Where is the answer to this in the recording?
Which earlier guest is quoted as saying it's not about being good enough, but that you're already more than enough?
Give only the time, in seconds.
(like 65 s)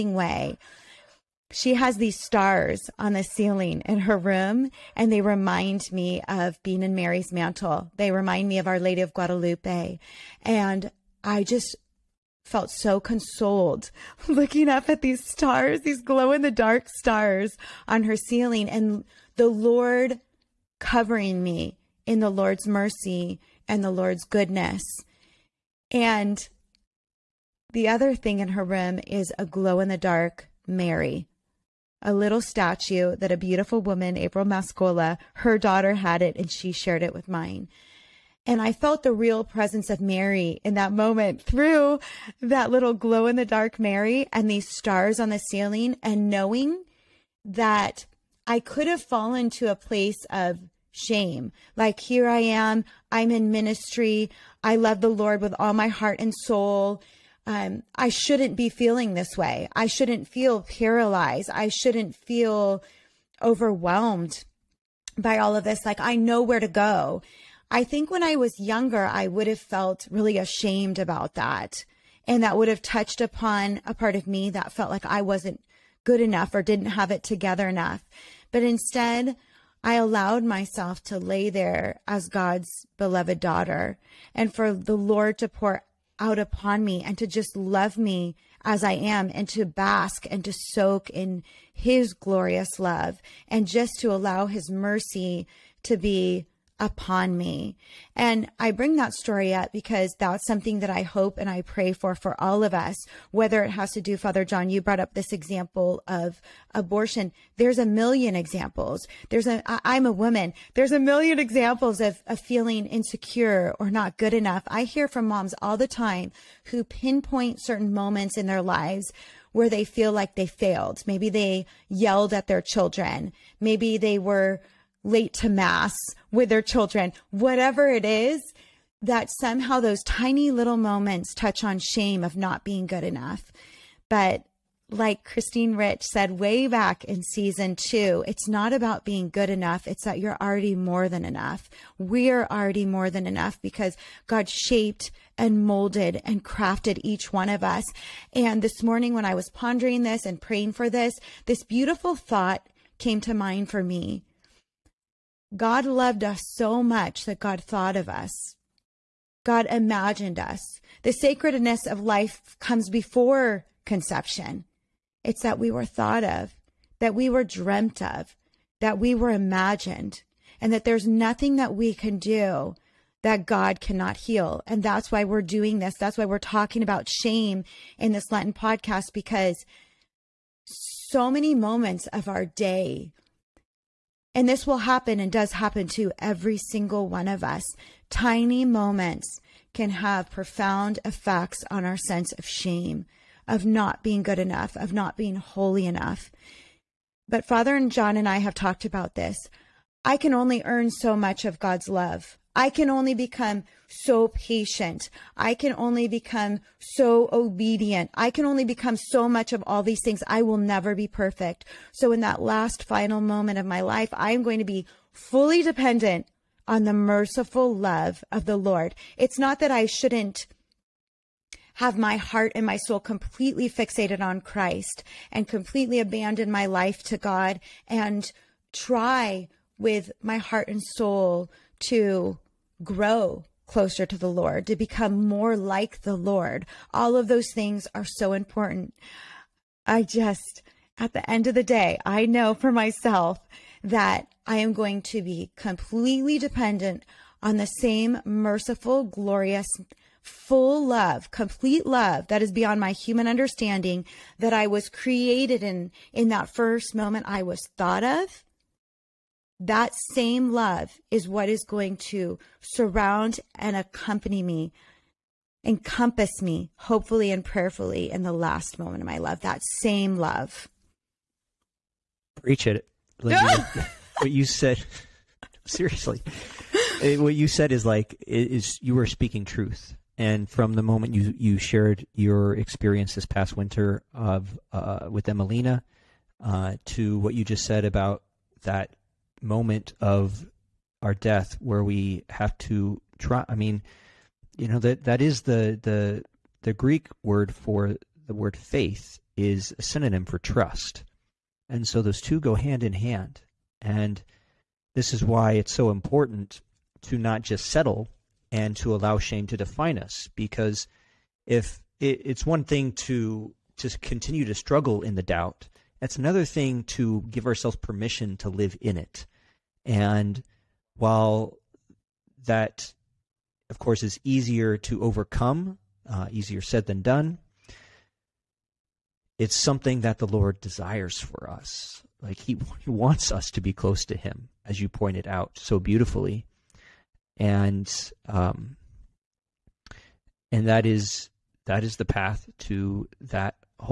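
135 s.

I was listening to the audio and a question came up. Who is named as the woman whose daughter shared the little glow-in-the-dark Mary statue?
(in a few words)
April Mascola.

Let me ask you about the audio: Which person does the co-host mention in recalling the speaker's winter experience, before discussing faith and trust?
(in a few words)
Emelina.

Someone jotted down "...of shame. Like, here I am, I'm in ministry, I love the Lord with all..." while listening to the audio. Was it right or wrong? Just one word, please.
right.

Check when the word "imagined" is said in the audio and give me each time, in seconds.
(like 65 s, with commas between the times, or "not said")
159 s, 169 s.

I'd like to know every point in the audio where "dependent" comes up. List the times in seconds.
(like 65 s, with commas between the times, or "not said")
215 s, 246 s.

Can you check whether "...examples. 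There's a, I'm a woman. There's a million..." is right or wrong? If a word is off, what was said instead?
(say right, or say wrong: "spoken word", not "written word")
right.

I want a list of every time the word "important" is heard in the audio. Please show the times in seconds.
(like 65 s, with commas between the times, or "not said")
238 s, 305 s.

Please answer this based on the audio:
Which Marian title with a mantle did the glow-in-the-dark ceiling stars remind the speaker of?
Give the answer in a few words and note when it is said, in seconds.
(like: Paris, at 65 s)
Our Lady of Guadalupe, at 8 s.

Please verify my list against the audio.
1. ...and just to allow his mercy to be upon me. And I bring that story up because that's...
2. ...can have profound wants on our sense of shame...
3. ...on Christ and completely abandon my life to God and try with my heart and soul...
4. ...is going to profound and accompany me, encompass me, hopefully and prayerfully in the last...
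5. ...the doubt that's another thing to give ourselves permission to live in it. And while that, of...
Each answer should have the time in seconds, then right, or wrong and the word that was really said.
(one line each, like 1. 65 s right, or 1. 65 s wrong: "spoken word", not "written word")
1. 93 s right
2. 189 s wrong: "effects", not "wants"
3. 224 s right
4. 261 s wrong: "surround", not "profound"
5. 315 s right.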